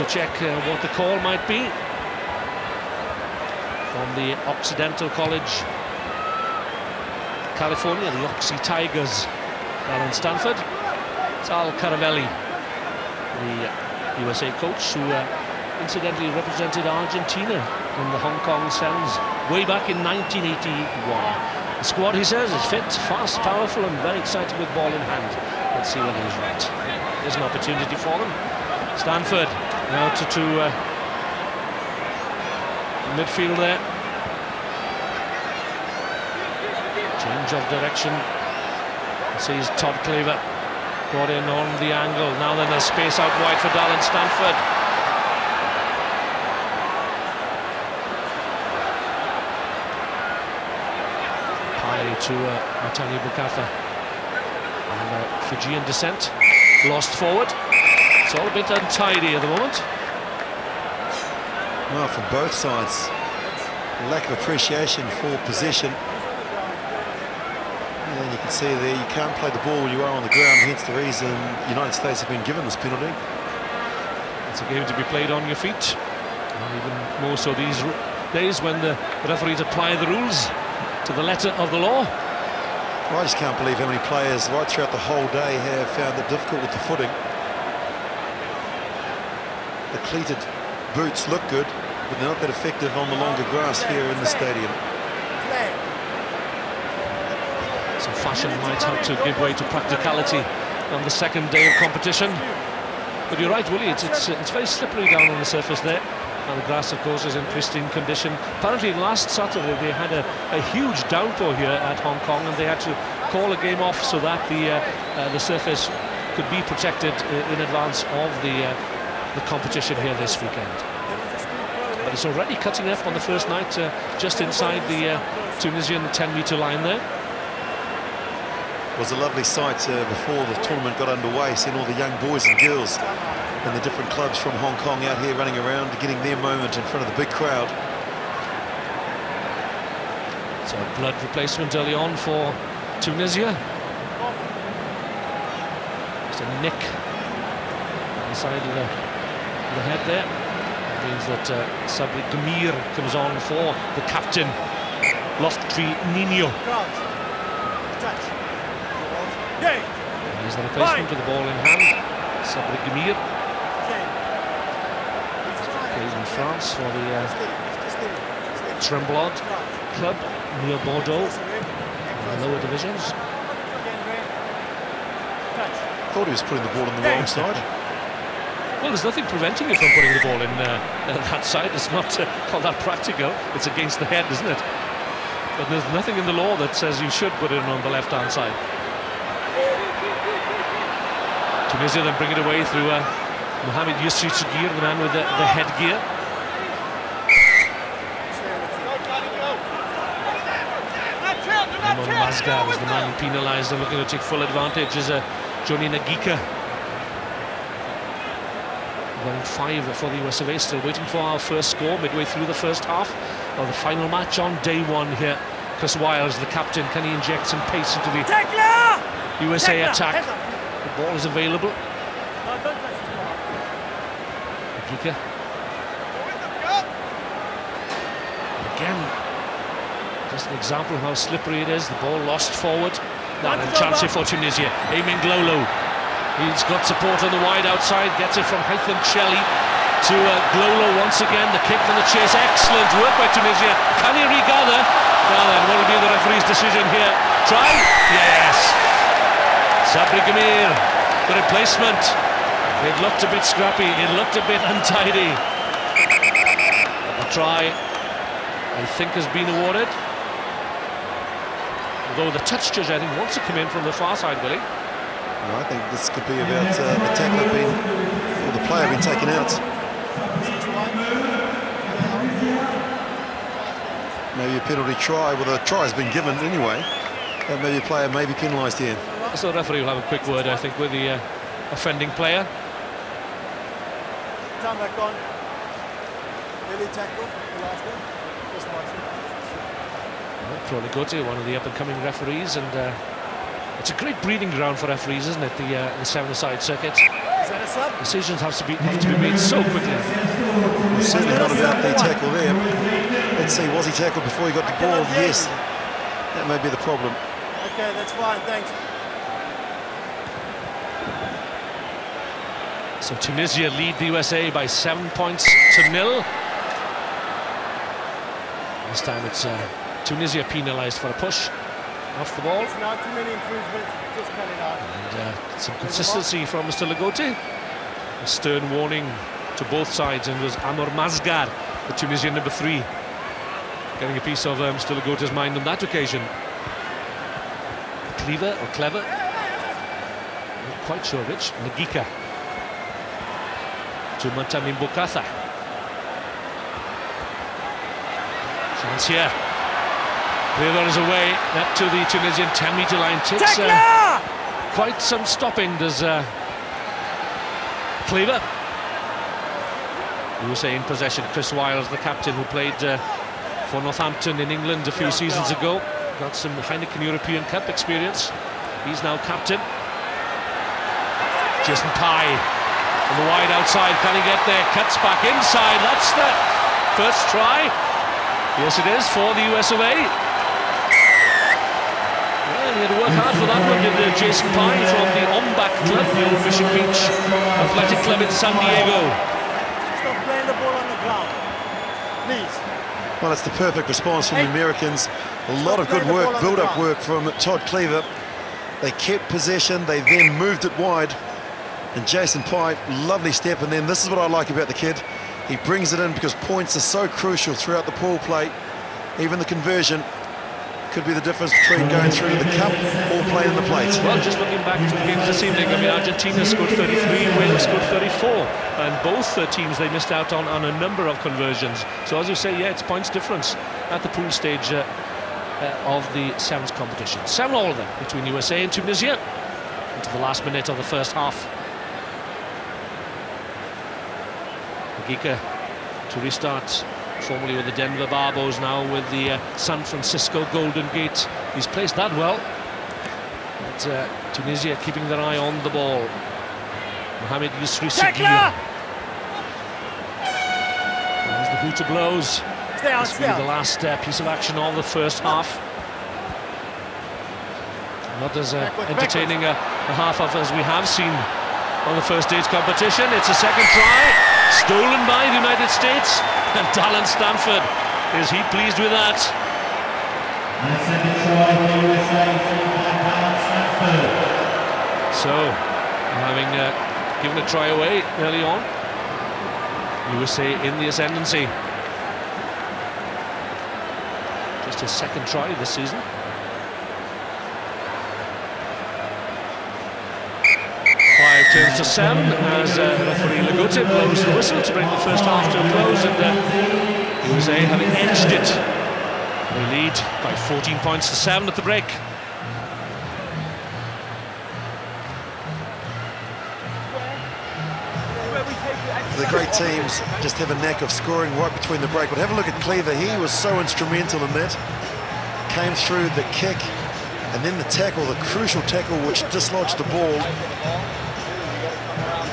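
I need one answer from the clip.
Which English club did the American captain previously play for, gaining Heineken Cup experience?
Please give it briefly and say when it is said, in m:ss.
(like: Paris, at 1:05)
Northampton, at 6:03.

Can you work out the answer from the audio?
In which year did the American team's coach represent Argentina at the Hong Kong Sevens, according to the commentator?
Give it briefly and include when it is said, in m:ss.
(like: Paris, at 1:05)
1981, at 0:20.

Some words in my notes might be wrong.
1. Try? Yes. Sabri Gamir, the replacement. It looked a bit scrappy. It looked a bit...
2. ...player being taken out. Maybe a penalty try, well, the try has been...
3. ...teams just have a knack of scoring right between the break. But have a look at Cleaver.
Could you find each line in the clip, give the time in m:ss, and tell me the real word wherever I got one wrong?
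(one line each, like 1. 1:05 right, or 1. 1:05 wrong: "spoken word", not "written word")
1. 4:07 right
2. 4:28 right
3. 8:29 right.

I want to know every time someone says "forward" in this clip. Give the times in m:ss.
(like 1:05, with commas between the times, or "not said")
0:57, 3:52.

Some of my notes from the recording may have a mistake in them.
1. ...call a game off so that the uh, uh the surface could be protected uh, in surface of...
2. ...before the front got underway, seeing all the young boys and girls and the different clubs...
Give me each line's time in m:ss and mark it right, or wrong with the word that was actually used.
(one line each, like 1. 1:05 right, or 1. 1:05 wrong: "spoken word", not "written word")
1. 1:53 wrong: "advance", not "surface"
2. 2:10 wrong: "tournament", not "front".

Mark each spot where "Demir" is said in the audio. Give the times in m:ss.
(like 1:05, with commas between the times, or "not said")
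2:32, 2:42.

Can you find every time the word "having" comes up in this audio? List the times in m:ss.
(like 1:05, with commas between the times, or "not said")
7:56, 8:17.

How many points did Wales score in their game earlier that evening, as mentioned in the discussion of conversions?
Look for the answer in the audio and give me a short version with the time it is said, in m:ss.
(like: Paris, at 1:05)
34, at 6:57.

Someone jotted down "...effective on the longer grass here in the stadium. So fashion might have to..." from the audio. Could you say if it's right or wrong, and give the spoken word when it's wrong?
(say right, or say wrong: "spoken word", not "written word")
right.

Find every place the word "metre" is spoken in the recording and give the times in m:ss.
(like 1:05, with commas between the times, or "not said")
2:06, 5:52.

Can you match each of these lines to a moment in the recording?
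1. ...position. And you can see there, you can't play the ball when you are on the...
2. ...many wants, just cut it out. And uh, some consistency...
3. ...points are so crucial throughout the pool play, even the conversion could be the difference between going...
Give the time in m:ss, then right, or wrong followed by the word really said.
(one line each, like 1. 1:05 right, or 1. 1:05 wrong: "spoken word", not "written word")
1. 1:05 right
2. 5:23 wrong: "improvements", not "wants"
3. 6:46 right.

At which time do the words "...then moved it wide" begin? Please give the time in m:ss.
6:40.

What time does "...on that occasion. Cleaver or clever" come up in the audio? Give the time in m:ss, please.
5:35.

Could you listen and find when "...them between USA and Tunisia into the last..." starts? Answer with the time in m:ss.
7:07.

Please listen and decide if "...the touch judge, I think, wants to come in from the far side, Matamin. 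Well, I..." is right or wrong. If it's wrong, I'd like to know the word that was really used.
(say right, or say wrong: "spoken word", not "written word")
wrong: "Willie", not "Matamin".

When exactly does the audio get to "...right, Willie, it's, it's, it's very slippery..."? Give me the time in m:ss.
1:43.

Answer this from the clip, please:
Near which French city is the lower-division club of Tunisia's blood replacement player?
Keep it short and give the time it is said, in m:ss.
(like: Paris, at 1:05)
Bordeaux, at 2:50.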